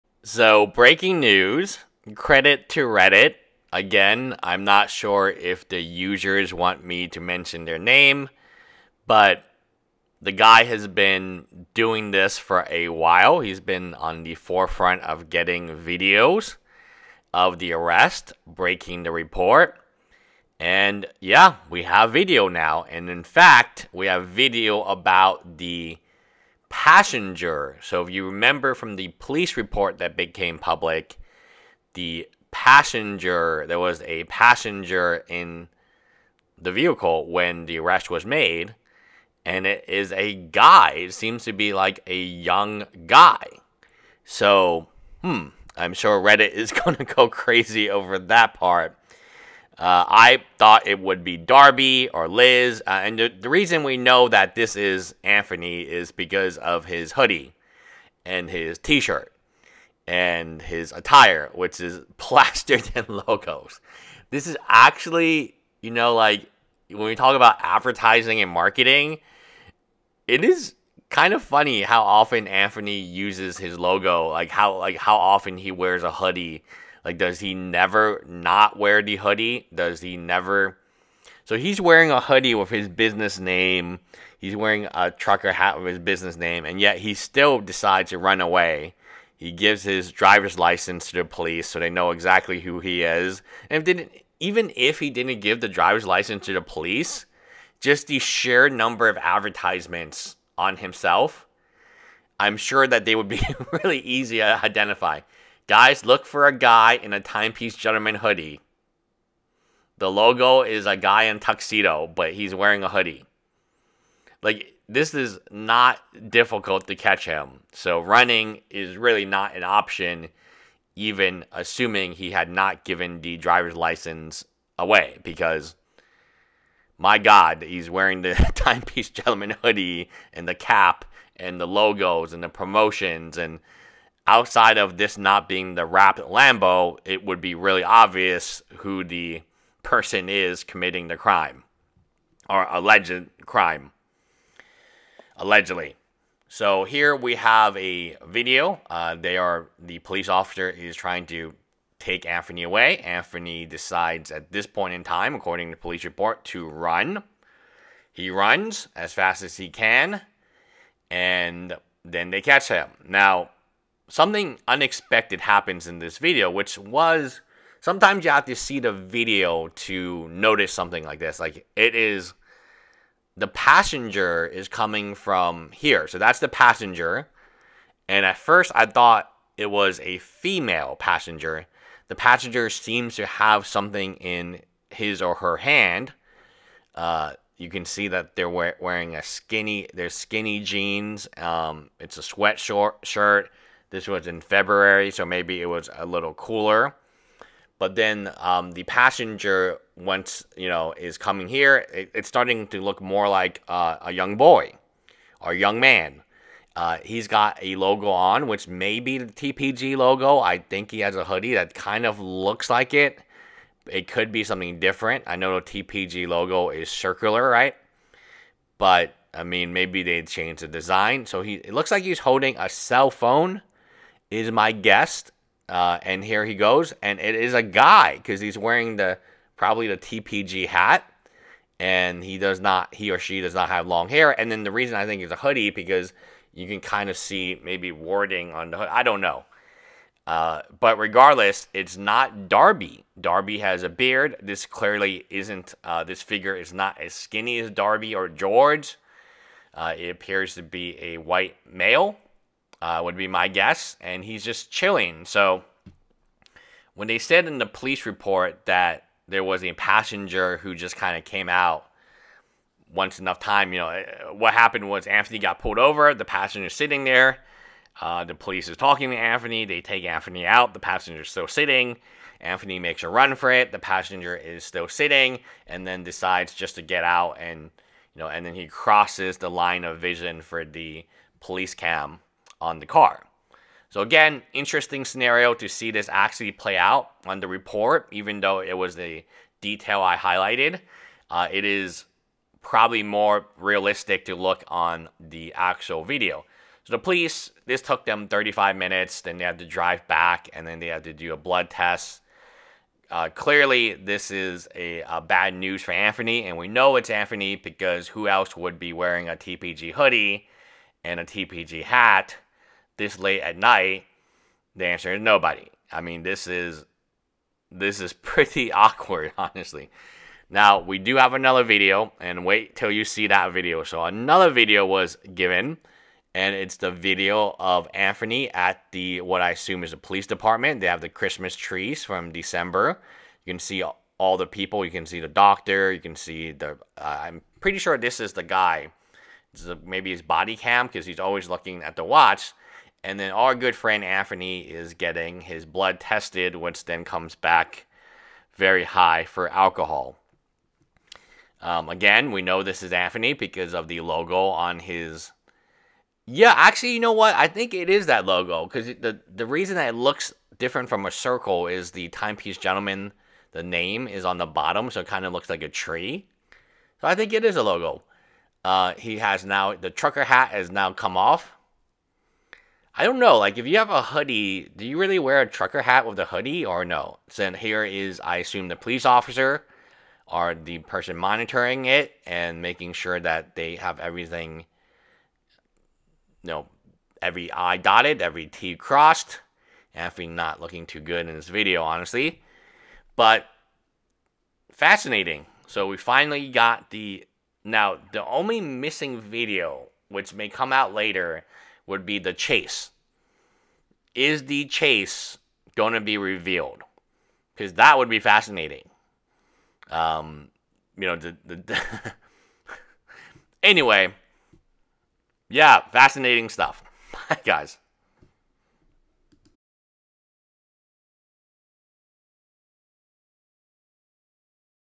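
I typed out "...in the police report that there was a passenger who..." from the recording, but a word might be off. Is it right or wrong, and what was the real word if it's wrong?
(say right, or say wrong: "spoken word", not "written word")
right.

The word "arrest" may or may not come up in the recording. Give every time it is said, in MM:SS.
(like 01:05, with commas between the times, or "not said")
00:17, 00:37.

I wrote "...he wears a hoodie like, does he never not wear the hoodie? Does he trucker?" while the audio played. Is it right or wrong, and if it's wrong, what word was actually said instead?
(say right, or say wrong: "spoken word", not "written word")
wrong: "never", not "trucker".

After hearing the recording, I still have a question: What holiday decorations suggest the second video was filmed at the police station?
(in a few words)
Christmas trees.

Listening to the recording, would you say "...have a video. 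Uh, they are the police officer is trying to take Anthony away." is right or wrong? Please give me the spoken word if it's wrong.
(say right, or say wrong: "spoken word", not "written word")
right.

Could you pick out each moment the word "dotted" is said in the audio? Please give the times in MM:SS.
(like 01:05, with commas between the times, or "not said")
06:27.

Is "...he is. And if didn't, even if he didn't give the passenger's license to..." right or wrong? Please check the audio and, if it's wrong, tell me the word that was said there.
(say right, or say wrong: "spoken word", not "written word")
wrong: "driver", not "passenger".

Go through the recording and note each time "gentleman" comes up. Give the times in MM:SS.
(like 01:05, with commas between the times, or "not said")
01:47, 02:09, 06:02.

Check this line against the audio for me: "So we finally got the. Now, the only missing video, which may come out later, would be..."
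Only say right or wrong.
right.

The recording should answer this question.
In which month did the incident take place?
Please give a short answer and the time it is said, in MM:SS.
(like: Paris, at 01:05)
February, at 03:14.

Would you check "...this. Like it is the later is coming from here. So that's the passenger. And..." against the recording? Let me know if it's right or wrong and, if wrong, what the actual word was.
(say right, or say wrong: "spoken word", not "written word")
wrong: "passenger", not "later".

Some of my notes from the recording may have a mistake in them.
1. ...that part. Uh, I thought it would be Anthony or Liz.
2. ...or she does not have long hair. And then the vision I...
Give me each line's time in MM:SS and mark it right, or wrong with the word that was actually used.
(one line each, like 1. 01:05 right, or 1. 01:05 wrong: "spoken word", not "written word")
1. 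00:48 wrong: "Darby", not "Anthony"
2. 03:53 wrong: "reason", not "vision".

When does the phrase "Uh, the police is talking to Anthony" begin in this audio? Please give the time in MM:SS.
04:27.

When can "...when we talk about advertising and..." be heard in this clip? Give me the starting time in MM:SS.
01:06.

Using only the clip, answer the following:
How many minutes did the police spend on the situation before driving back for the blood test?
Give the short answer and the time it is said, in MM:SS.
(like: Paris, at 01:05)
35, at 04:58.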